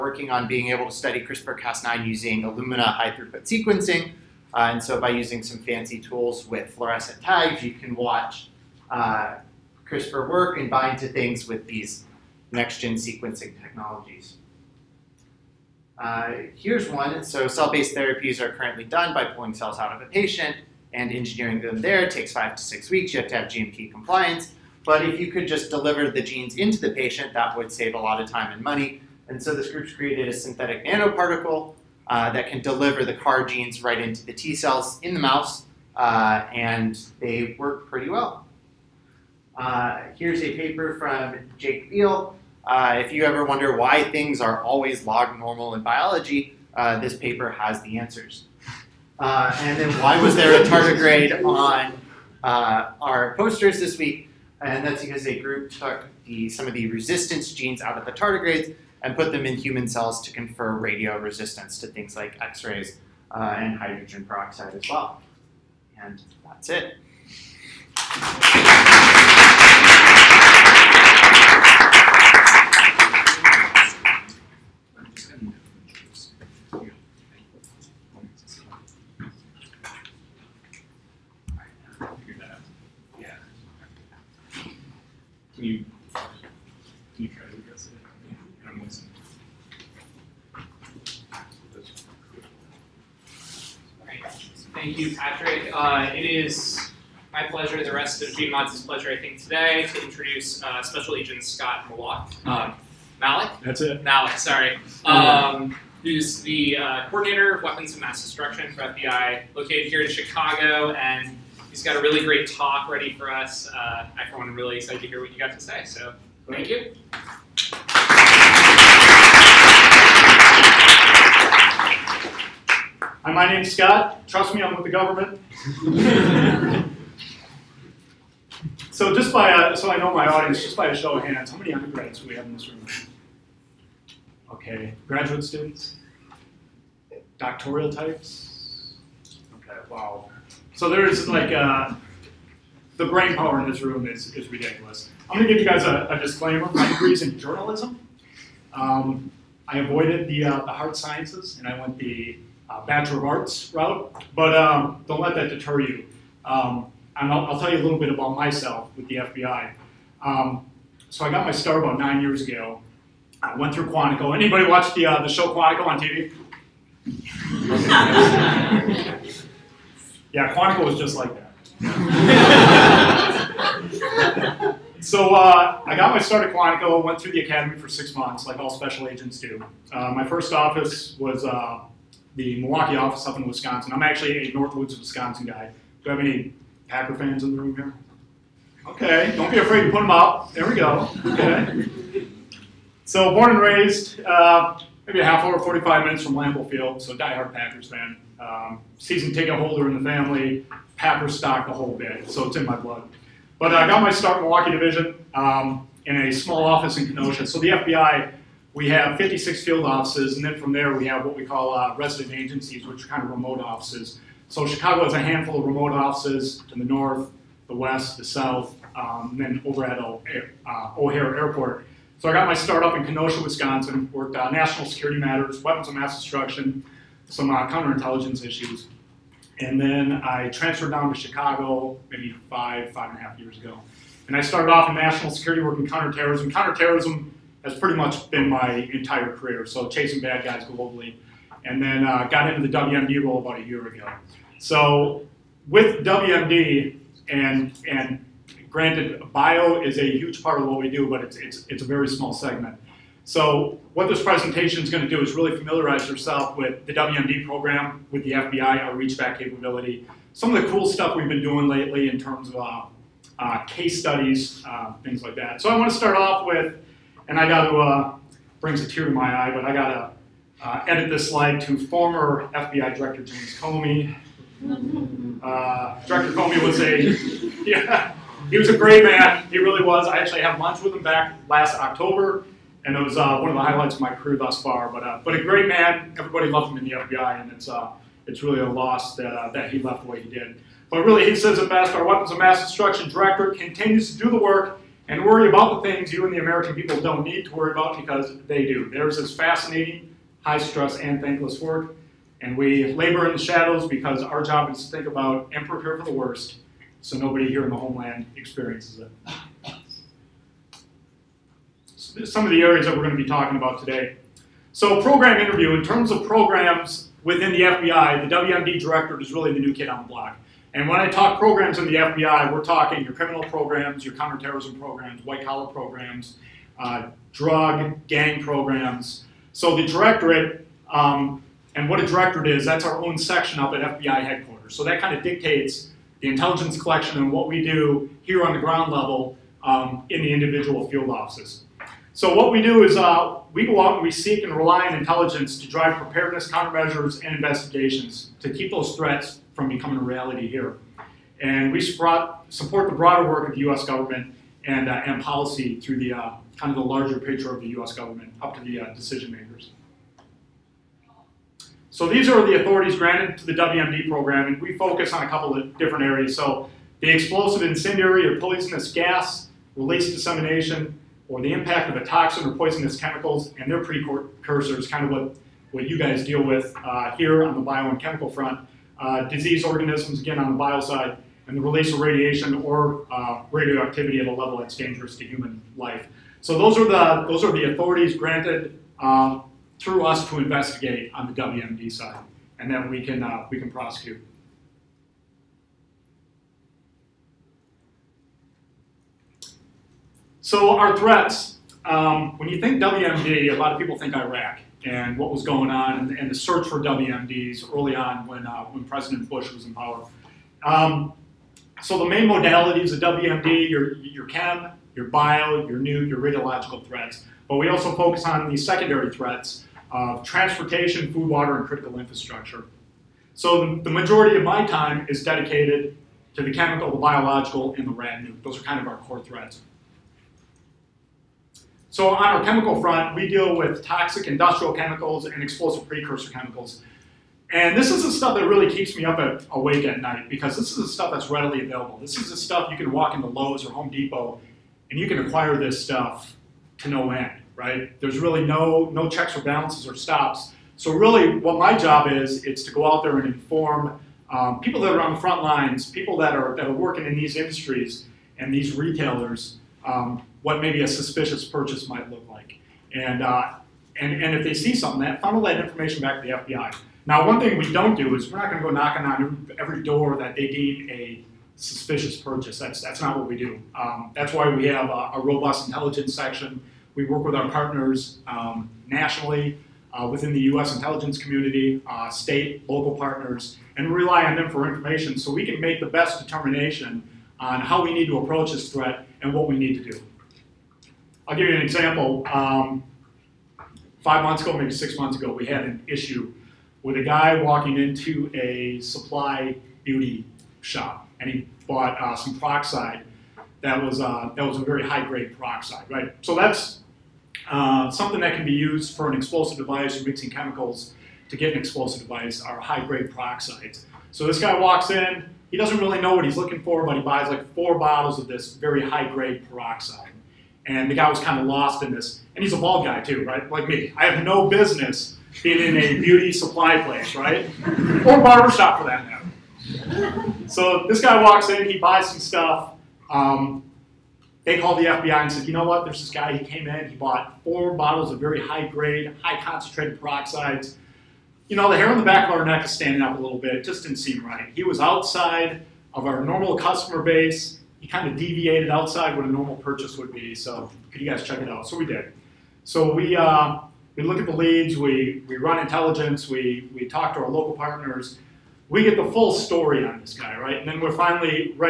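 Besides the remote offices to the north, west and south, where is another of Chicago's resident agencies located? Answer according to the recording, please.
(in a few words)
O'Hare Airport.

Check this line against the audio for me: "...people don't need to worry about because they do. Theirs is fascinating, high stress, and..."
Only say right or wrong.
right.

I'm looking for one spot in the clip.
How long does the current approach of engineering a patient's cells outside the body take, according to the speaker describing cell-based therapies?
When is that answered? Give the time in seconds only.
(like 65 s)
22 s.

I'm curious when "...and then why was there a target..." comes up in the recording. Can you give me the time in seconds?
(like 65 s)
49 s.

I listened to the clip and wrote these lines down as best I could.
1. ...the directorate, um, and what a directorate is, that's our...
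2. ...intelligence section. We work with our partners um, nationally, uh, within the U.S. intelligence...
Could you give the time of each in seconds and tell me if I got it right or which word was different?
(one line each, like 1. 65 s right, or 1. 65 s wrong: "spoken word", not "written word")
1. 329 s right
2. 475 s right.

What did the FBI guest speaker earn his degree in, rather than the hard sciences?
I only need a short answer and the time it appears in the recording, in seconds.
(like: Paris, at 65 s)
Journalism, at 147 s.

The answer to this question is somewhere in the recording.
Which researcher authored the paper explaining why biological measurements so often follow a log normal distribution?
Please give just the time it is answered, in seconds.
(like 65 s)
41 s.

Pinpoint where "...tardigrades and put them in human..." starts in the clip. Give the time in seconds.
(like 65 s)
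58 s.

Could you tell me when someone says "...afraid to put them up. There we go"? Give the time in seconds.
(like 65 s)
189 s.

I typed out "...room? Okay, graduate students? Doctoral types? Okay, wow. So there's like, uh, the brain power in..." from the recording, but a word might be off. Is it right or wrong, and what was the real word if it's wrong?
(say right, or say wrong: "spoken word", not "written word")
right.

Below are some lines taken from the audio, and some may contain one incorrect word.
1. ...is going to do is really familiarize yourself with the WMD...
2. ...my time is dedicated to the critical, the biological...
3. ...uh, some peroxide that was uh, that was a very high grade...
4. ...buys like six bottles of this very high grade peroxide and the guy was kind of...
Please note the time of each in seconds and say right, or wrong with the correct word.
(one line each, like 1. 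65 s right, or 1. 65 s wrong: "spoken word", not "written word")
1. 254 s right
2. 424 s wrong: "chemical", not "critical"
3. 502 s right
4. 517 s wrong: "four", not "six".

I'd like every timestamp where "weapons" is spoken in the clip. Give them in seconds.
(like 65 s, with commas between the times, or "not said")
107 s, 225 s, 292 s.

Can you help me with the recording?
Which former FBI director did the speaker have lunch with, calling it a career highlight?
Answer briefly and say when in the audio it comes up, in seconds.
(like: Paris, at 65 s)
James Comey, at 273 s.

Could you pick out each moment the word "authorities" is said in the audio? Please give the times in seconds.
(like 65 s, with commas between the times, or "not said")
362 s, 387 s.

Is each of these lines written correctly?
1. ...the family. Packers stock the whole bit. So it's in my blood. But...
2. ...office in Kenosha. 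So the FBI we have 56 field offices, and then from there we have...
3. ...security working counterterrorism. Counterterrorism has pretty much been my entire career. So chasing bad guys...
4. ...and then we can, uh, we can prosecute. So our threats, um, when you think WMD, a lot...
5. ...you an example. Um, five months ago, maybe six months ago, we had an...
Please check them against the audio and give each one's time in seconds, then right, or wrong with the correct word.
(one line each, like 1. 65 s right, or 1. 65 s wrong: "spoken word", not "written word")
1. 200 s right
2. 206 s right
3. 235 s right
4. 392 s right
5. 491 s right.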